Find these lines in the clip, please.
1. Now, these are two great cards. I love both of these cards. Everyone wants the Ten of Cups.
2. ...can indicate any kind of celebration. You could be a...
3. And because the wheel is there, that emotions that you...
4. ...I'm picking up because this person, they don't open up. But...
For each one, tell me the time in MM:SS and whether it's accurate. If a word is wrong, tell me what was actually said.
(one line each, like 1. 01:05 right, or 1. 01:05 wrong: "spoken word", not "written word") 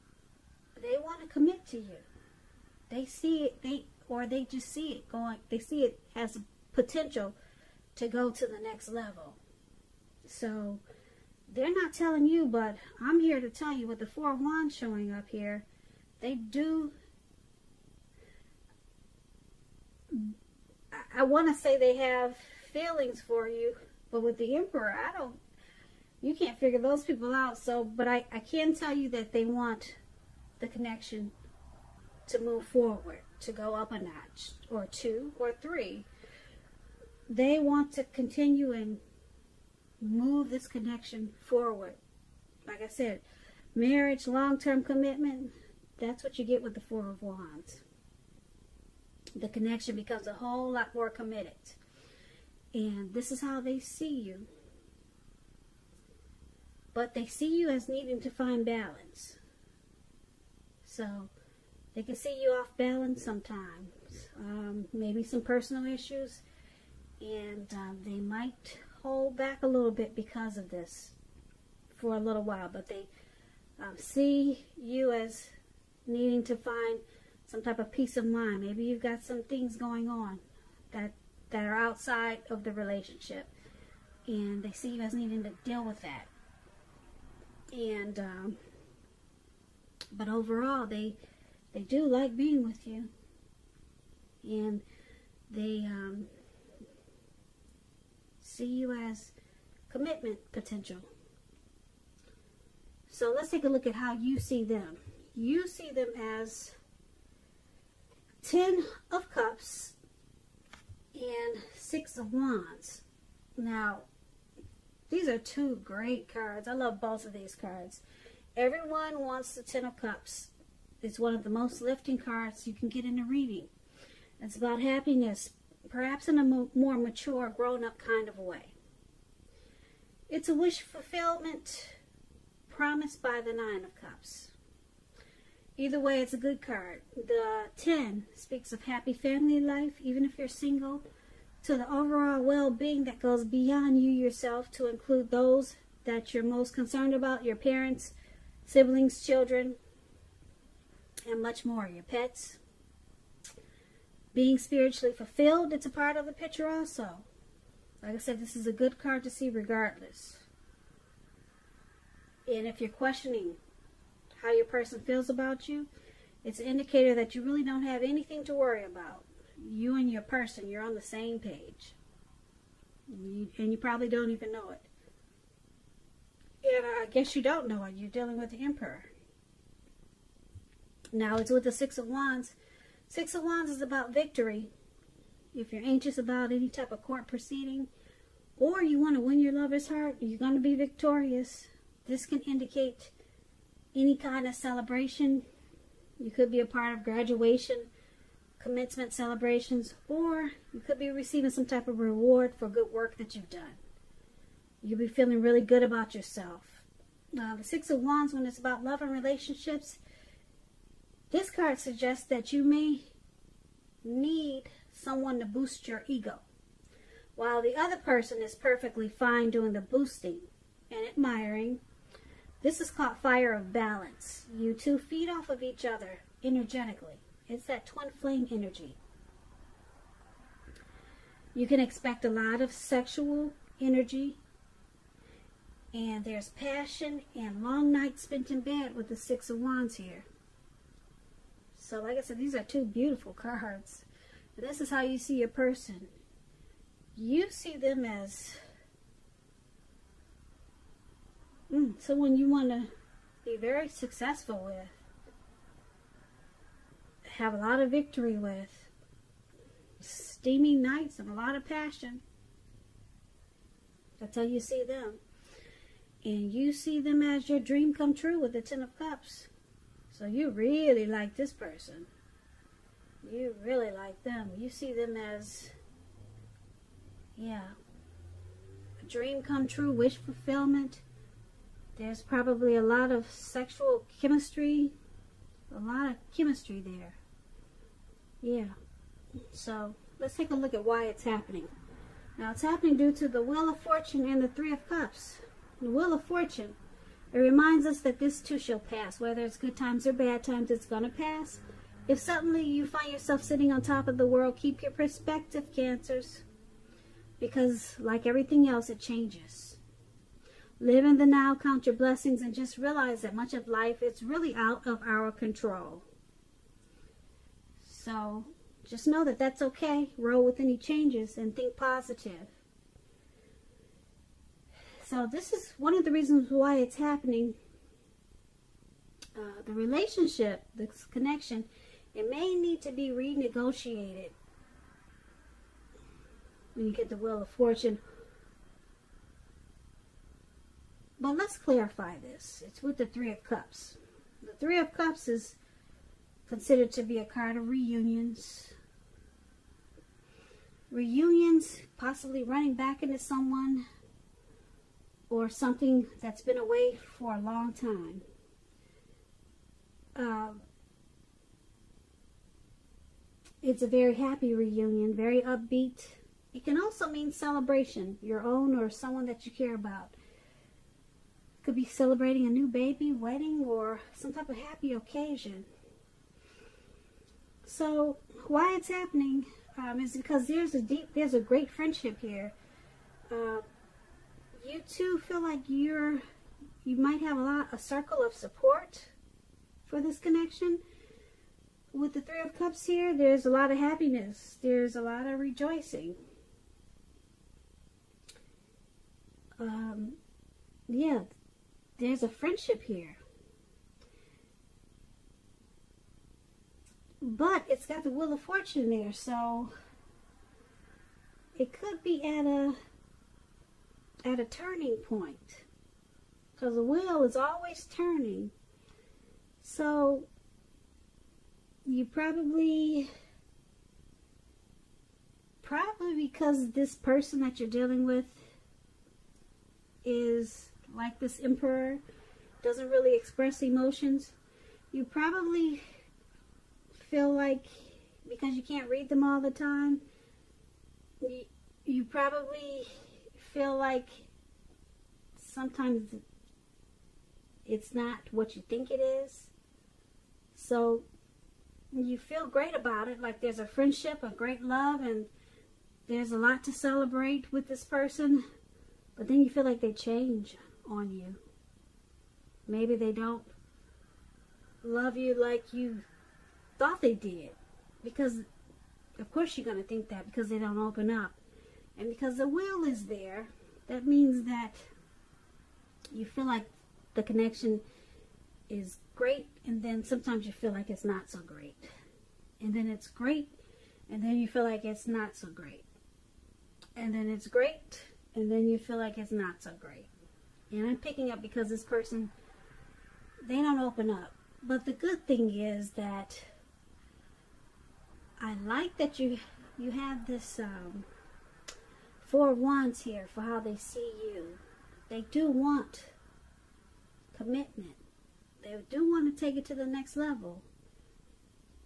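1. 01:53 right
2. 03:12 right
3. 07:51 wrong: "means", not "emotions"
4. 08:10 right.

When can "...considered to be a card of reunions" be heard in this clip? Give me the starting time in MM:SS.
05:46.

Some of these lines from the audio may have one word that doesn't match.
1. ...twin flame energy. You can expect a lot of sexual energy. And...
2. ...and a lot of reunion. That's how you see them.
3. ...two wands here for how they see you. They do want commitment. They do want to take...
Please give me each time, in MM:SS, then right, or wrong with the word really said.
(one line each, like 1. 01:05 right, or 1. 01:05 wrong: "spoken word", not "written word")
1. 03:47 right
2. 04:21 wrong: "passion", not "reunion"
3. 08:22 wrong: "four", not "two".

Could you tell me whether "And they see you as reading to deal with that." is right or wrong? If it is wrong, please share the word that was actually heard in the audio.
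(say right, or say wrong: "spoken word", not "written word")
wrong: "needing", not "reading".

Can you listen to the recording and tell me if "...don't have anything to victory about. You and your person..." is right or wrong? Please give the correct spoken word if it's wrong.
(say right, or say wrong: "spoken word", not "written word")
wrong: "worry", not "victory".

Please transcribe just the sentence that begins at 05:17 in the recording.
So, just know that that's okay.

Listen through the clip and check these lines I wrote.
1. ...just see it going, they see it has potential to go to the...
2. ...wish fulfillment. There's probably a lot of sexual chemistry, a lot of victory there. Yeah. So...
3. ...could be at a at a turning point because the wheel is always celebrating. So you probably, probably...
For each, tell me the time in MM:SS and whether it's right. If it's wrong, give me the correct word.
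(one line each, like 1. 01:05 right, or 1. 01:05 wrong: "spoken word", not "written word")
1. 00:04 right
2. 04:39 wrong: "chemistry", not "victory"
3. 06:51 wrong: "turning", not "celebrating".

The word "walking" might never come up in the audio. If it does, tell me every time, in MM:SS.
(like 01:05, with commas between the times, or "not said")
not said.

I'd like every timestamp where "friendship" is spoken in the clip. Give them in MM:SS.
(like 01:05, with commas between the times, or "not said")
06:21, 06:42, 07:33.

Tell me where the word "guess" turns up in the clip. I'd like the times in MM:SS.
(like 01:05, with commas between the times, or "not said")
02:57.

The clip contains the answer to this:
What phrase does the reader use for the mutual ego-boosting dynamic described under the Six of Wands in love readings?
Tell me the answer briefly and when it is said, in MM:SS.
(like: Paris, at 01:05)
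fire of balance, at 03:43.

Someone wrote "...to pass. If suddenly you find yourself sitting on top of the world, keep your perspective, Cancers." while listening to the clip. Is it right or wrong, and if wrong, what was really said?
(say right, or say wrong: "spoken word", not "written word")
right.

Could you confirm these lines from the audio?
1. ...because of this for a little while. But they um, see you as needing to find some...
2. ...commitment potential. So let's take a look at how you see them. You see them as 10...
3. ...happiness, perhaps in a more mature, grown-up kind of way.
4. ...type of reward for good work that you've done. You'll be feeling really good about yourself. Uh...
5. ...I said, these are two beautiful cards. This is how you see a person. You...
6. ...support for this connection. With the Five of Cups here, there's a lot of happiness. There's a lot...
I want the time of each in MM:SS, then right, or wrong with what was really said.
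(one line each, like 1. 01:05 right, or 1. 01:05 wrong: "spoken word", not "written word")
1. 01:10 right
2. 01:39 right
3. 02:04 right
4. 03:21 right
5. 04:02 right
6. 06:28 wrong: "Three", not "Five".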